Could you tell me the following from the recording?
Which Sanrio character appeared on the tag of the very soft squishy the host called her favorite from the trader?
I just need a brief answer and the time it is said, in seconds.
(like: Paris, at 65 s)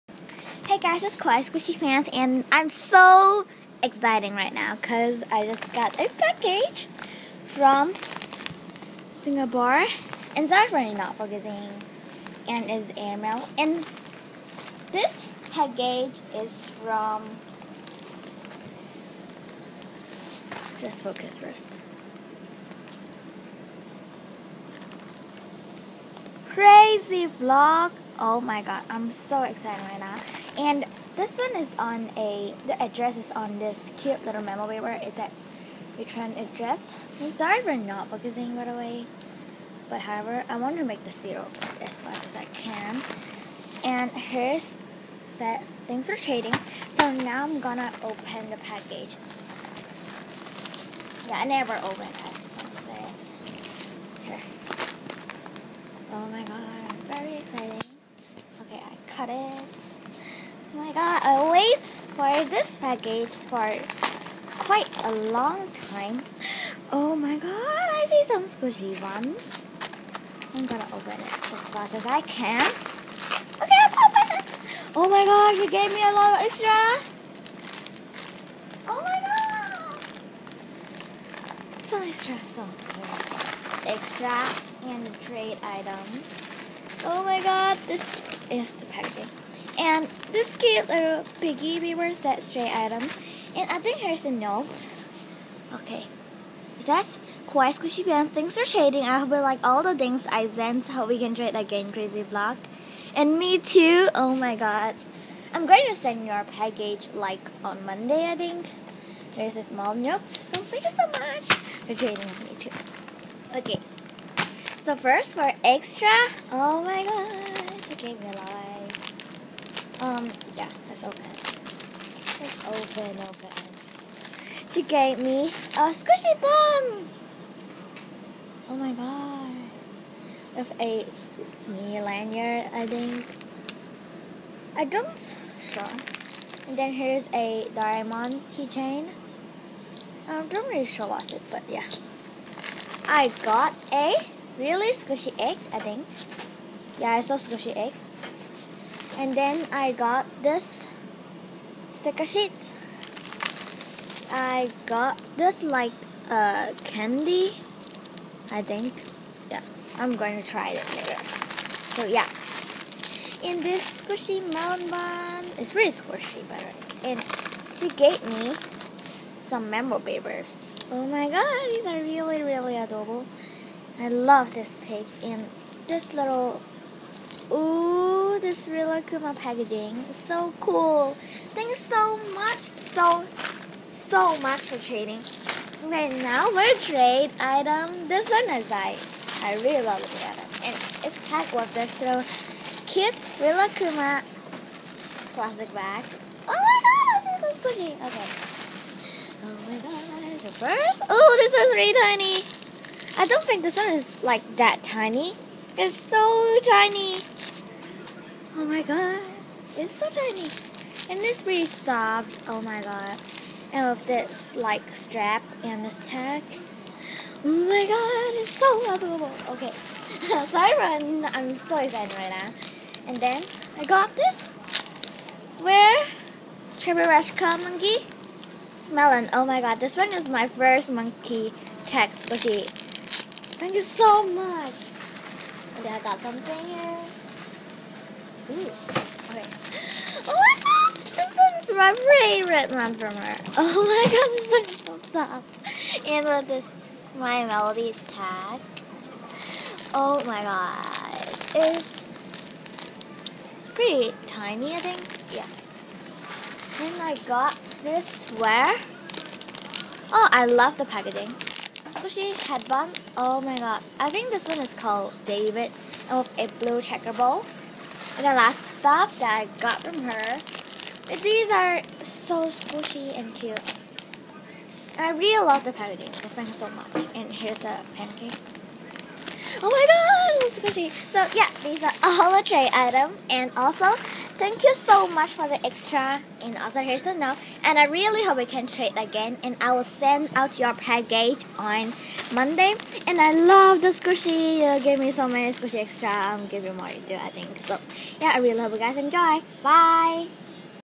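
My Melody, at 247 s.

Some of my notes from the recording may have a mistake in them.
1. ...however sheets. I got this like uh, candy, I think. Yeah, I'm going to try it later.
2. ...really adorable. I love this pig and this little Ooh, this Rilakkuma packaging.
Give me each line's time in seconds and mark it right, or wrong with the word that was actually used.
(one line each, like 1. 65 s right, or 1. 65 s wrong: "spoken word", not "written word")
1. 151 s wrong: "sticker", not "however"
2. 172 s right.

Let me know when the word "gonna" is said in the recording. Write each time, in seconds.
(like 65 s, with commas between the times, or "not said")
47 s, 70 s.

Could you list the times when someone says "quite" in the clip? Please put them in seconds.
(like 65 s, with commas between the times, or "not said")
64 s.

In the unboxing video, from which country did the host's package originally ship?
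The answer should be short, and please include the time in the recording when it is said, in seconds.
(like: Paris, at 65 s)
Singapore, at 9 s.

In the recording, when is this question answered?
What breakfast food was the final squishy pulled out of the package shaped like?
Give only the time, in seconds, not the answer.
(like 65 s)
277 s.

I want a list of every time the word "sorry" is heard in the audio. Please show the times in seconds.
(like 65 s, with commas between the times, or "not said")
10 s, 37 s.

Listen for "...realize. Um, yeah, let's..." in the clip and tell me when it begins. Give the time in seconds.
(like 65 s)
118 s.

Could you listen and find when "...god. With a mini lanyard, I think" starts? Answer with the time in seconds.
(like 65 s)
128 s.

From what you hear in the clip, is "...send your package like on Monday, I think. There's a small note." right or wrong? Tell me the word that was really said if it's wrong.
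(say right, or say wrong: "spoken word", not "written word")
right.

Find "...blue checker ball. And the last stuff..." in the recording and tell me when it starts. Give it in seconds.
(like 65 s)
266 s.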